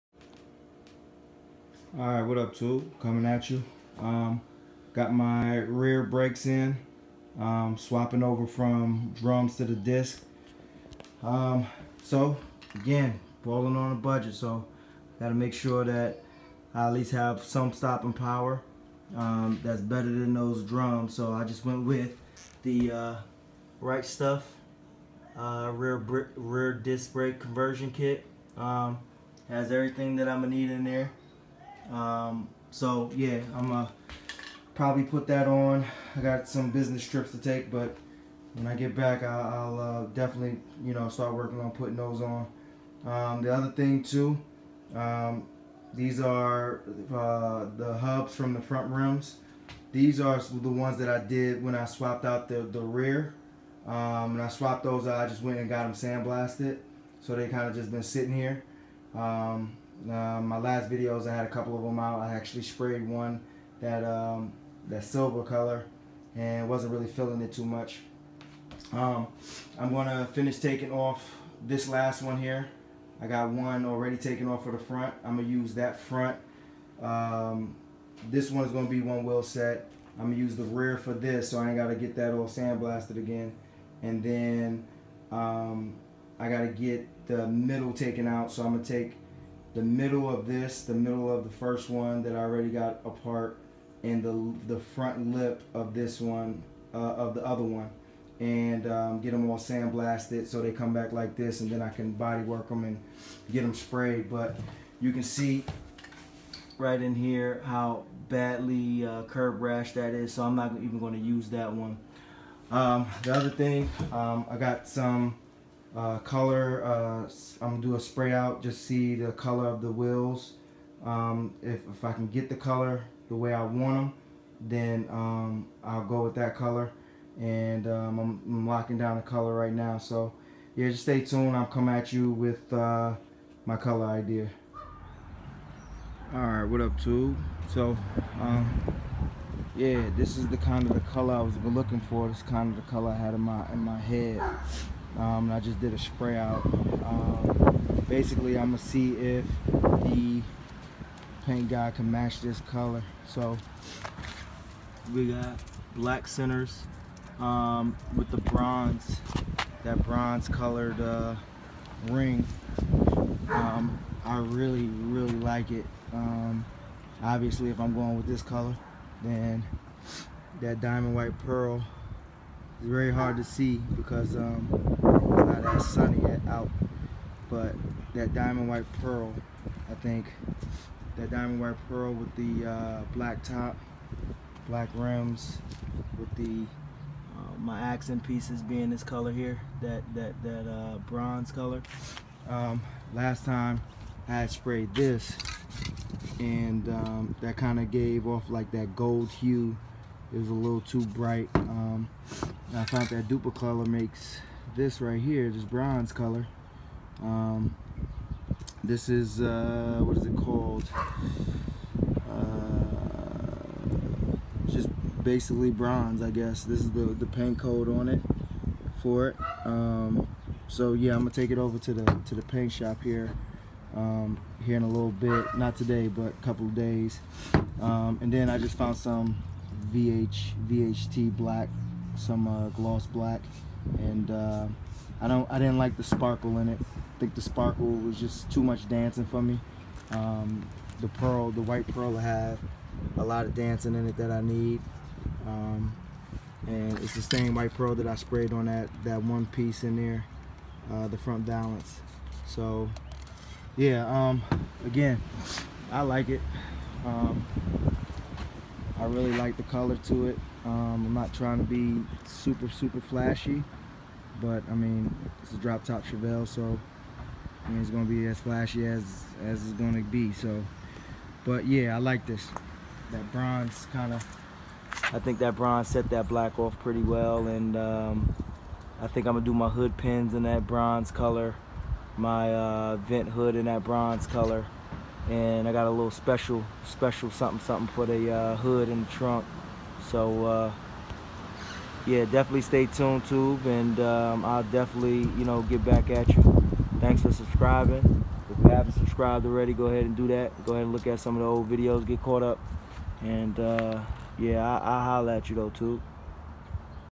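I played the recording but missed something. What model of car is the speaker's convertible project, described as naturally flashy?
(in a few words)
Chevelle.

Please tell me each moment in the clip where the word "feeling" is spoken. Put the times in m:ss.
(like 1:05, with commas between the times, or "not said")
1:07.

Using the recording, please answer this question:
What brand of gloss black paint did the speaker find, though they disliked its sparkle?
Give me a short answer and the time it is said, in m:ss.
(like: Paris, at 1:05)
VHT, at 3:50.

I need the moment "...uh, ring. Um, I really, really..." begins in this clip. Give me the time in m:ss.
2:41.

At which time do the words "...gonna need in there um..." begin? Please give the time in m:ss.
0:30.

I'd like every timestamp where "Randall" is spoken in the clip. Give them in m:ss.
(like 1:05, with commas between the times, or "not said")
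not said.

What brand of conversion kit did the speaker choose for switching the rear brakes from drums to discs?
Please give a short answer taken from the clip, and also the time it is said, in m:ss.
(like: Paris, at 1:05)
Right Stuff, at 0:23.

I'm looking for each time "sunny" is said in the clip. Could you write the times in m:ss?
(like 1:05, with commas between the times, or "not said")
2:55.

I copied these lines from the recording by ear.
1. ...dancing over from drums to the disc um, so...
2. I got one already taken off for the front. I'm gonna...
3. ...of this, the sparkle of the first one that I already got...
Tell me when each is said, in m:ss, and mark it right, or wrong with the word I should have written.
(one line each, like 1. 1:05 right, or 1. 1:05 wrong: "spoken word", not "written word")
1. 0:07 wrong: "swapping", not "dancing"
2. 1:13 right
3. 1:30 wrong: "middle", not "sparkle".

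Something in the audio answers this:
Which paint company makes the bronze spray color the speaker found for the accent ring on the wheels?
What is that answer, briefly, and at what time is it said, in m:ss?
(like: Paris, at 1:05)
Dupli-Color, at 3:23.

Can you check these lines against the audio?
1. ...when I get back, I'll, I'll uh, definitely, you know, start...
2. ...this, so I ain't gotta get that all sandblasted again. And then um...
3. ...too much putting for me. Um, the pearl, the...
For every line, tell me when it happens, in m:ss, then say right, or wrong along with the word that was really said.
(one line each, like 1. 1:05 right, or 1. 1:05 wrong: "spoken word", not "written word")
1. 0:38 right
2. 1:21 right
3. 3:58 wrong: "dancing", not "putting".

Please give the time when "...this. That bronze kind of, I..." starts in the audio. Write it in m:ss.
4:32.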